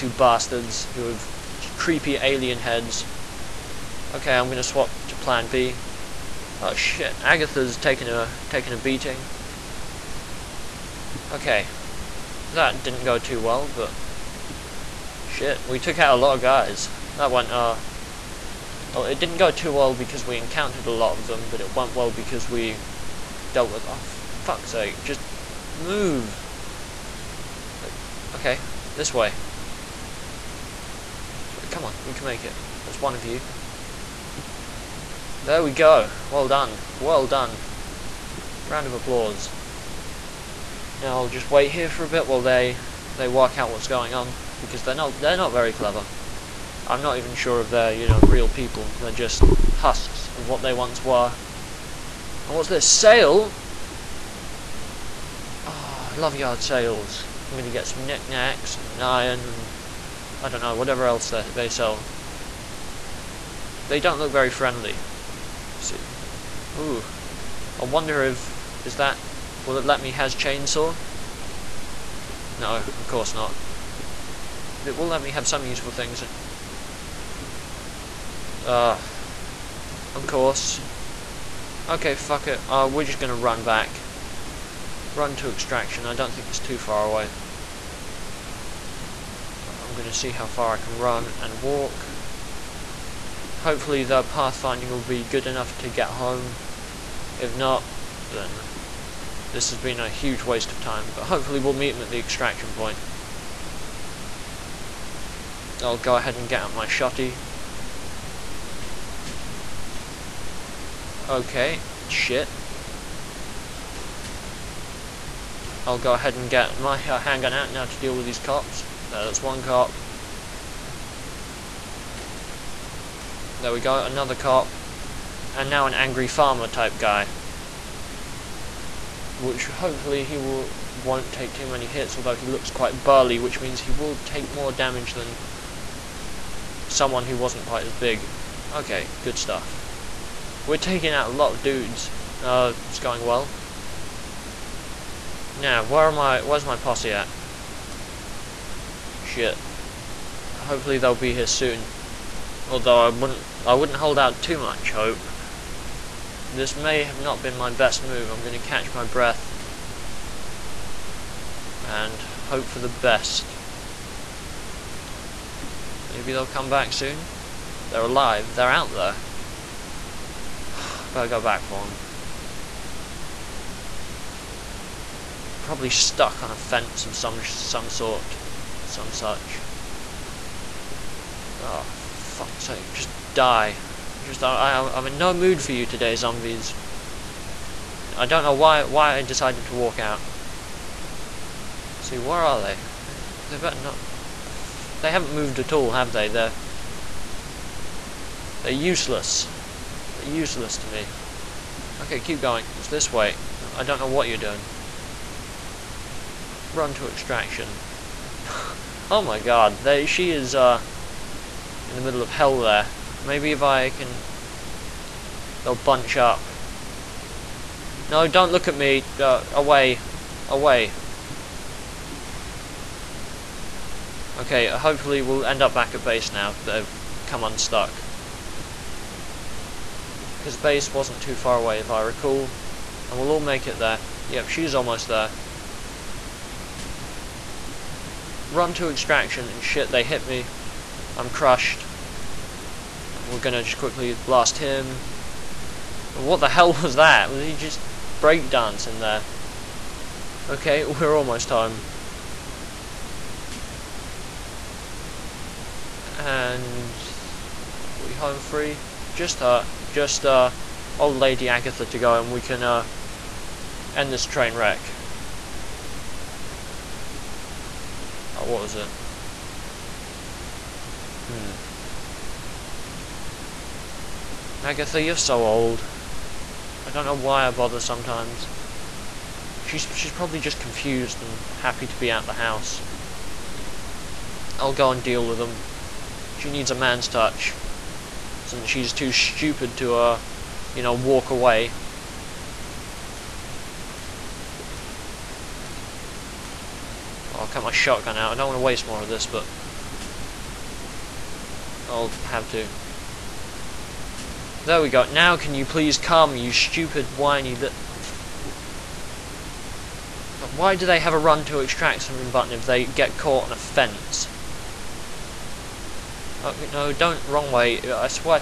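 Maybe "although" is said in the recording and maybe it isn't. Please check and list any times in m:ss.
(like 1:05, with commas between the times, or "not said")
2:12, 2:32.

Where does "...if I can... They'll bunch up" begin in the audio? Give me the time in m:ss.
3:33.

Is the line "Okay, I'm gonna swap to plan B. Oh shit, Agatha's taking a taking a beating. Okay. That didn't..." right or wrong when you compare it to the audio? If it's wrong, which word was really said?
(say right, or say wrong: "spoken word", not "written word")
right.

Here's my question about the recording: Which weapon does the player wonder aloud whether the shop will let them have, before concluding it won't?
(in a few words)
Chainsaw.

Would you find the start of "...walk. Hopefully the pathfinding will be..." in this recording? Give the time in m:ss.
1:31.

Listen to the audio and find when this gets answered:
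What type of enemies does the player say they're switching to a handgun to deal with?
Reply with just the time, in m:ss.
1:58.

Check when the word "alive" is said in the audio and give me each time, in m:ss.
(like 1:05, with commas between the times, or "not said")
2:48.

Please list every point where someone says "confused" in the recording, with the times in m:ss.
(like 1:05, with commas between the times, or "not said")
4:40.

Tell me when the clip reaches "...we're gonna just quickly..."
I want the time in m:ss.
4:03.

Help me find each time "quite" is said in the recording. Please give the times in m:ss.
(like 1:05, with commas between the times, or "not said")
2:12, 2:17.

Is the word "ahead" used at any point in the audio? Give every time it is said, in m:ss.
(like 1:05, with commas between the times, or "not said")
1:46, 1:56.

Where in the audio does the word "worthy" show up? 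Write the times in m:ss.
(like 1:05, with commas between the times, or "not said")
not said.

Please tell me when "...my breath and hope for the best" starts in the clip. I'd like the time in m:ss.
2:38.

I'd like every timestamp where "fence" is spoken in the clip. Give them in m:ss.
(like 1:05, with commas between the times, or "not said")
2:56, 5:13.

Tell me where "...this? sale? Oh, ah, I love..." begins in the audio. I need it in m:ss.
0:52.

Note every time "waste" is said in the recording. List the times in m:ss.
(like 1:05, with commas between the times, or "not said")
1:40, 4:58.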